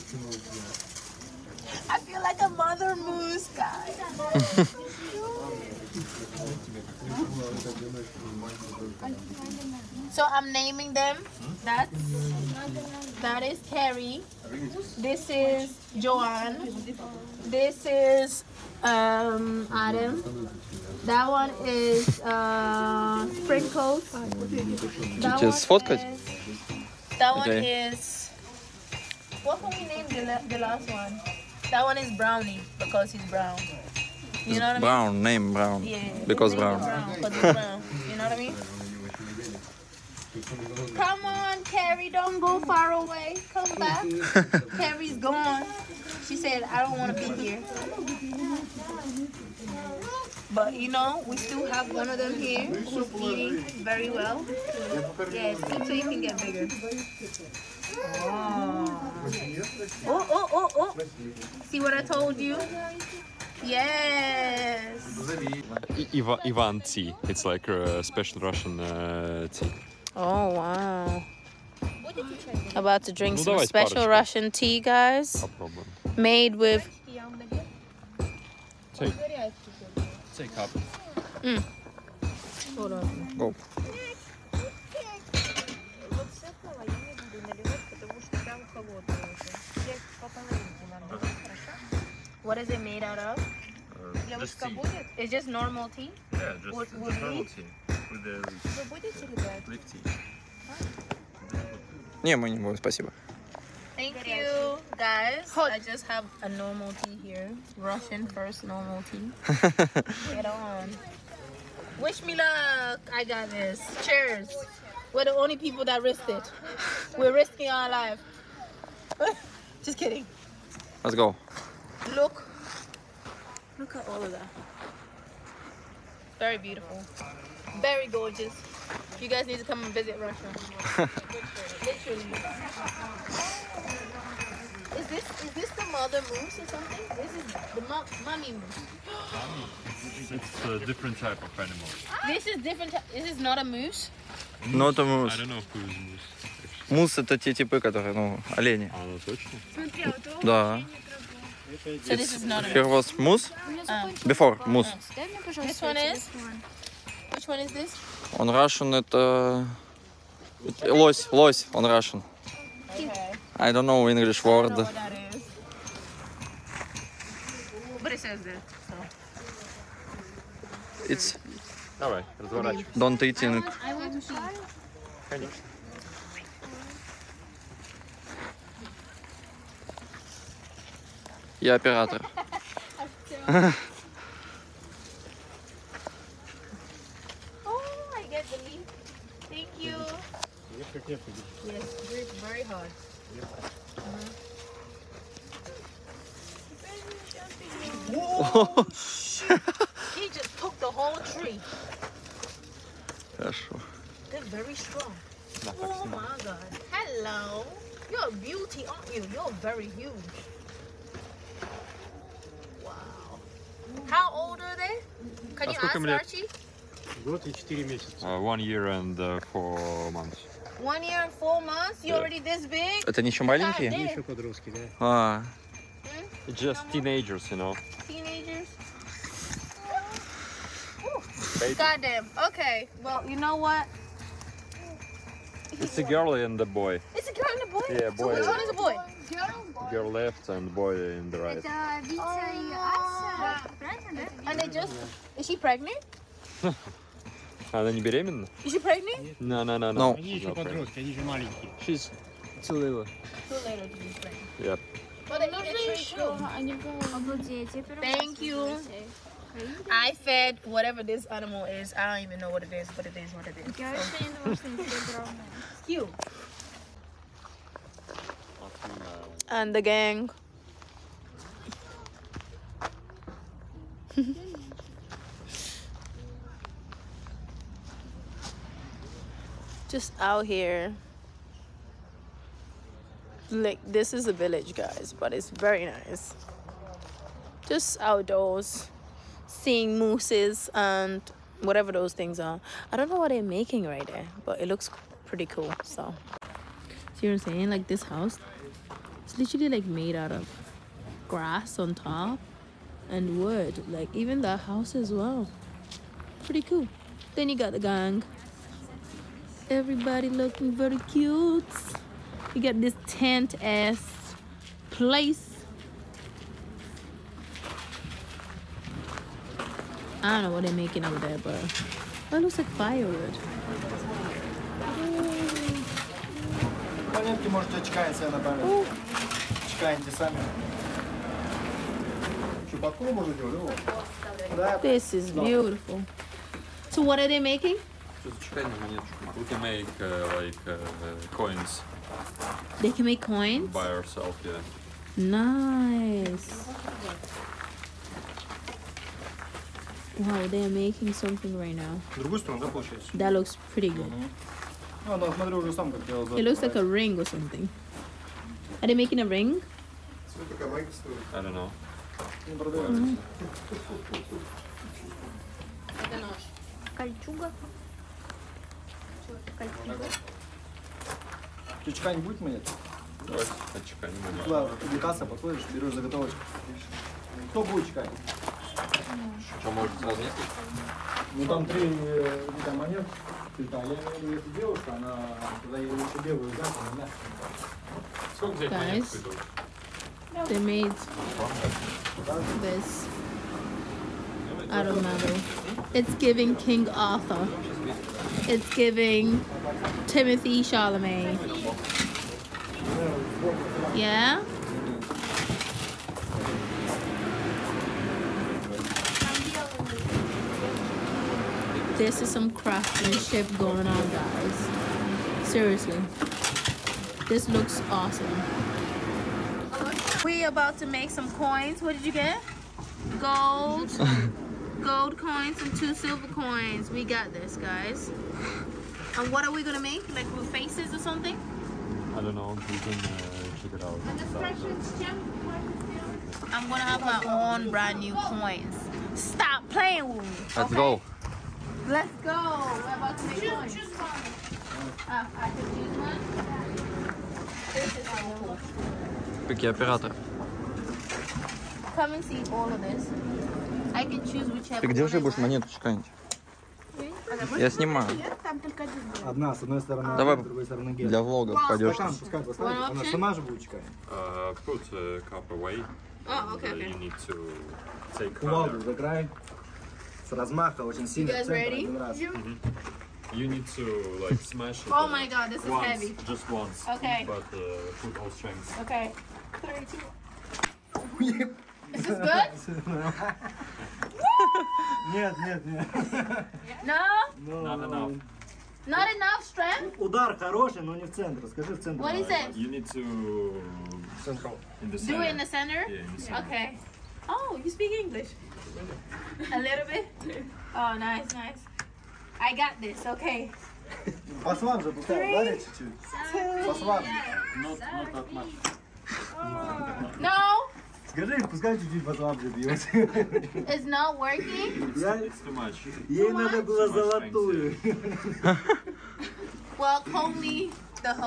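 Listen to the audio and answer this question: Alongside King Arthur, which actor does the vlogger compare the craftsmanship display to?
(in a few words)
Timothée Chalamet.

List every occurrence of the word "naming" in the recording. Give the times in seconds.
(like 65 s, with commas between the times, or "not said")
10 s.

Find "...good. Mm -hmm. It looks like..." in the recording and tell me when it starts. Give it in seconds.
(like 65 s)
353 s.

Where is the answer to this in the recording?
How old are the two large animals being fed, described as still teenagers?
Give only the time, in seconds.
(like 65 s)
218 s.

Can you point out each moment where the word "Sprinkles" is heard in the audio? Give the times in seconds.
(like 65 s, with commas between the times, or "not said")
23 s.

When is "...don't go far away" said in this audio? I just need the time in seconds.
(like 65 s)
42 s.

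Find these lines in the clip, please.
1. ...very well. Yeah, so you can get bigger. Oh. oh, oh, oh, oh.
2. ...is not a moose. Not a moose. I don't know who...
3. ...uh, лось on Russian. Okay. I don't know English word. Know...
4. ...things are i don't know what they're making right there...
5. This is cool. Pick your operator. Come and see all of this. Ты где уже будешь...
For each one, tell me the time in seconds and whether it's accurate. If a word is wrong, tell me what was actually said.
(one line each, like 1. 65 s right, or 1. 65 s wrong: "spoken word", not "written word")
1. 53 s right
2. 143 s right
3. 161 s right
4. 292 s right
5. 447 s right.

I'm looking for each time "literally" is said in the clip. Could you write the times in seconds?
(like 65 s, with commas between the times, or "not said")
131 s, 299 s.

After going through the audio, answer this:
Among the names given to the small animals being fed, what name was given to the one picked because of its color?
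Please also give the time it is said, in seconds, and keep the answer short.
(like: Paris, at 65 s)
Brownie, at 32 s.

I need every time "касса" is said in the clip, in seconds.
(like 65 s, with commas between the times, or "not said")
374 s.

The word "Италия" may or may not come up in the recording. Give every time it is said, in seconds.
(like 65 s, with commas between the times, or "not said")
383 s.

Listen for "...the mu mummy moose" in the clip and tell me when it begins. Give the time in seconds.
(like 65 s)
137 s.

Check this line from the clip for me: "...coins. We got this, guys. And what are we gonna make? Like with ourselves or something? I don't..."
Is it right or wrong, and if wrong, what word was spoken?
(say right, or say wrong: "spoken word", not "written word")
wrong: "faces", not "ourselves".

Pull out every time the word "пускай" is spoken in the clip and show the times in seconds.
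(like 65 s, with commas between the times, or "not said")
462 s, 511 s.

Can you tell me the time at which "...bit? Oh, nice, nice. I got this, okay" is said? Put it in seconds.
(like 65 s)
499 s.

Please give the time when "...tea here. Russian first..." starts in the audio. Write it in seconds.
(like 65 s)
107 s.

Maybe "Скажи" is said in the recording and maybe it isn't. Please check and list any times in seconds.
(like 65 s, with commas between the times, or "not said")
491 s, 511 s.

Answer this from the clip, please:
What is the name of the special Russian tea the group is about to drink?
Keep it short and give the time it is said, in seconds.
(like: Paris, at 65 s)
Ivan tea, at 66 s.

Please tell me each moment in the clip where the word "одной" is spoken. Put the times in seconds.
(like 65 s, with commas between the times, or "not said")
459 s.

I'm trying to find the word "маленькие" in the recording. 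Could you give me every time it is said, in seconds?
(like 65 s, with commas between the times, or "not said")
223 s, 251 s.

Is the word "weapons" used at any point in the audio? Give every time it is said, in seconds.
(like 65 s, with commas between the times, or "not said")
not said.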